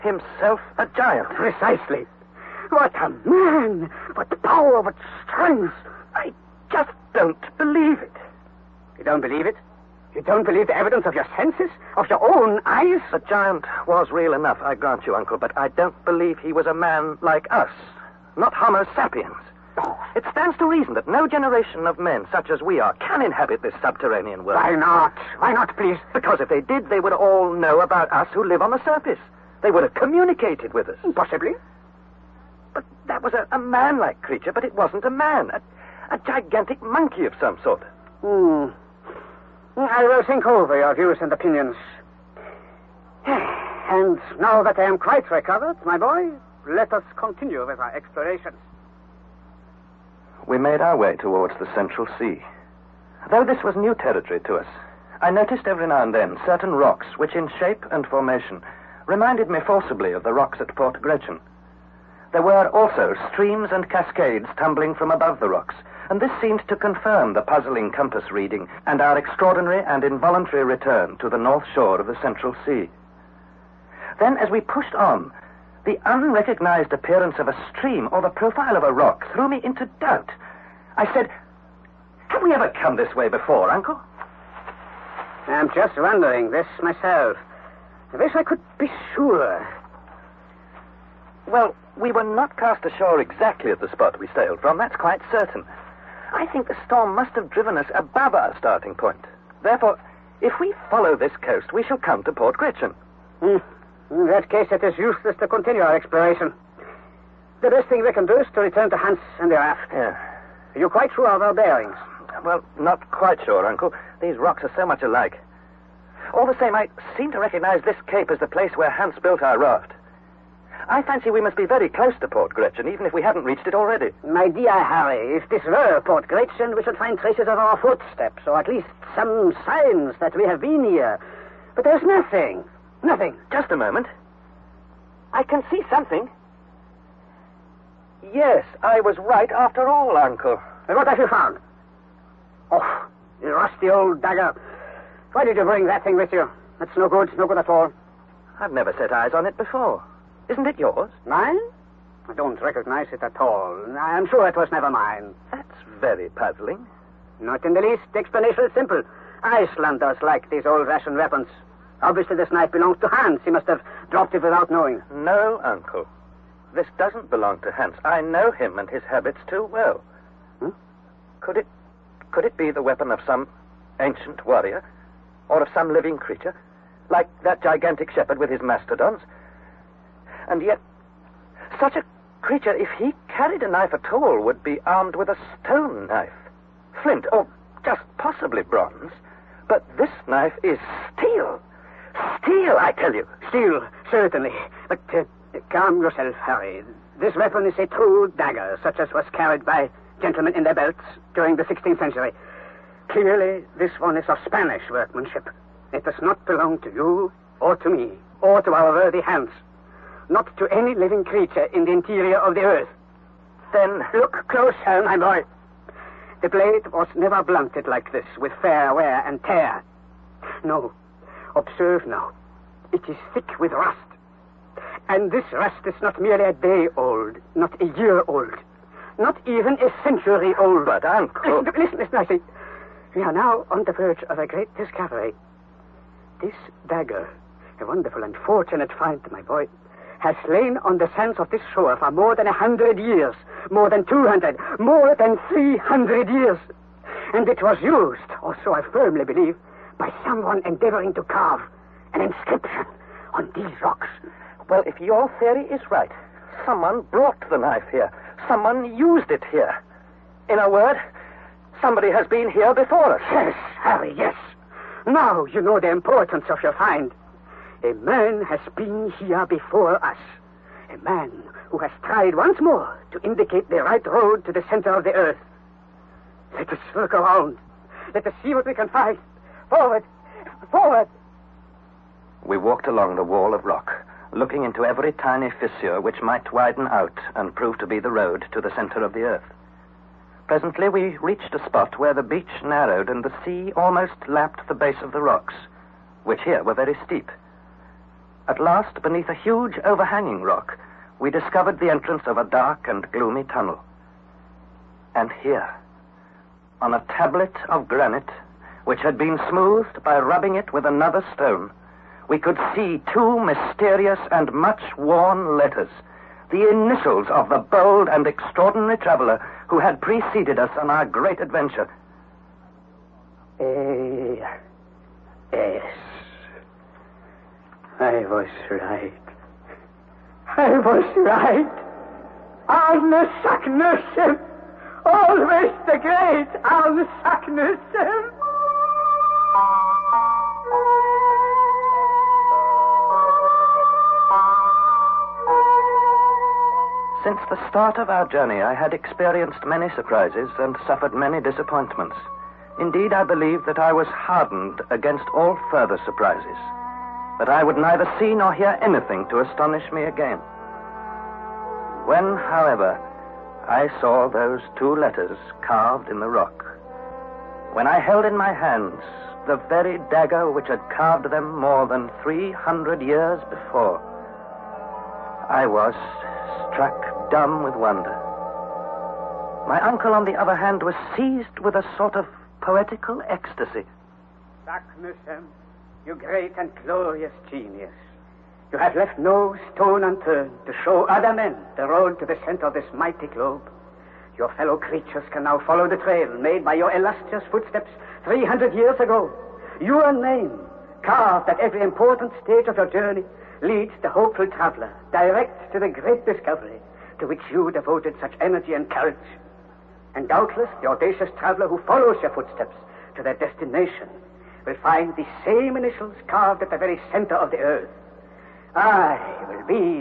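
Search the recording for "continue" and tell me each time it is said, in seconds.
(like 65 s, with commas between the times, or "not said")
47 s, 105 s.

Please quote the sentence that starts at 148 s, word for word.
I've never set eyes on it before.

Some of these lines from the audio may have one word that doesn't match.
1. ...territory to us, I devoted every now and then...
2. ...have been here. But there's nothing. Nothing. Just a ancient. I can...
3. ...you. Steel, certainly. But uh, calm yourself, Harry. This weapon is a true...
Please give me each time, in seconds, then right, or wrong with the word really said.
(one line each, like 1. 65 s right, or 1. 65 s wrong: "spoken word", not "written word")
1. 53 s wrong: "noticed", not "devoted"
2. 130 s wrong: "moment", not "ancient"
3. 193 s right.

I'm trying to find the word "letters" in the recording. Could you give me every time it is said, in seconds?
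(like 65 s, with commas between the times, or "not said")
315 s, 364 s.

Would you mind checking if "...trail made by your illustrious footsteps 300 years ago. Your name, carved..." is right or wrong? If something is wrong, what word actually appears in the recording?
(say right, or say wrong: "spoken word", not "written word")
right.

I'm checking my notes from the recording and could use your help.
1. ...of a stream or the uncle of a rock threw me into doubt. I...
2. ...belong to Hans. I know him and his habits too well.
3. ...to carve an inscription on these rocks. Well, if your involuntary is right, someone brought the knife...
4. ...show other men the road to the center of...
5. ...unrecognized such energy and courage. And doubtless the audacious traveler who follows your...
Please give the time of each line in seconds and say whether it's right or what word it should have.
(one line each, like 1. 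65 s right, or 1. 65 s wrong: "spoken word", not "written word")
1. 77 s wrong: "profile", not "uncle"
2. 167 s right
3. 251 s wrong: "theory", not "involuntary"
4. 390 s right
5. 407 s wrong: "devoted", not "unrecognized".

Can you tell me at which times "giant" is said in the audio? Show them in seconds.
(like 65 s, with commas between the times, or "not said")
0 s, 13 s.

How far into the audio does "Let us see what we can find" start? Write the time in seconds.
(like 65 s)
278 s.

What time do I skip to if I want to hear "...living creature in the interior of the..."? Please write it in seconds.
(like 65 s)
210 s.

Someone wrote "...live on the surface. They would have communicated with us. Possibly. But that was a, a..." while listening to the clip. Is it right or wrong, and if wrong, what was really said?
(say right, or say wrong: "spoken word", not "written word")
right.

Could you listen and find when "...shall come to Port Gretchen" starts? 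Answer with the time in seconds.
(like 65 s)
101 s.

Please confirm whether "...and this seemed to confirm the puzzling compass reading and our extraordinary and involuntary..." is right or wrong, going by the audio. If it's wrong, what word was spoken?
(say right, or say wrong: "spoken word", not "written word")
right.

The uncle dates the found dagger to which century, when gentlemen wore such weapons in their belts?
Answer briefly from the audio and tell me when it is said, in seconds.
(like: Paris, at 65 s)
16th century, at 201 s.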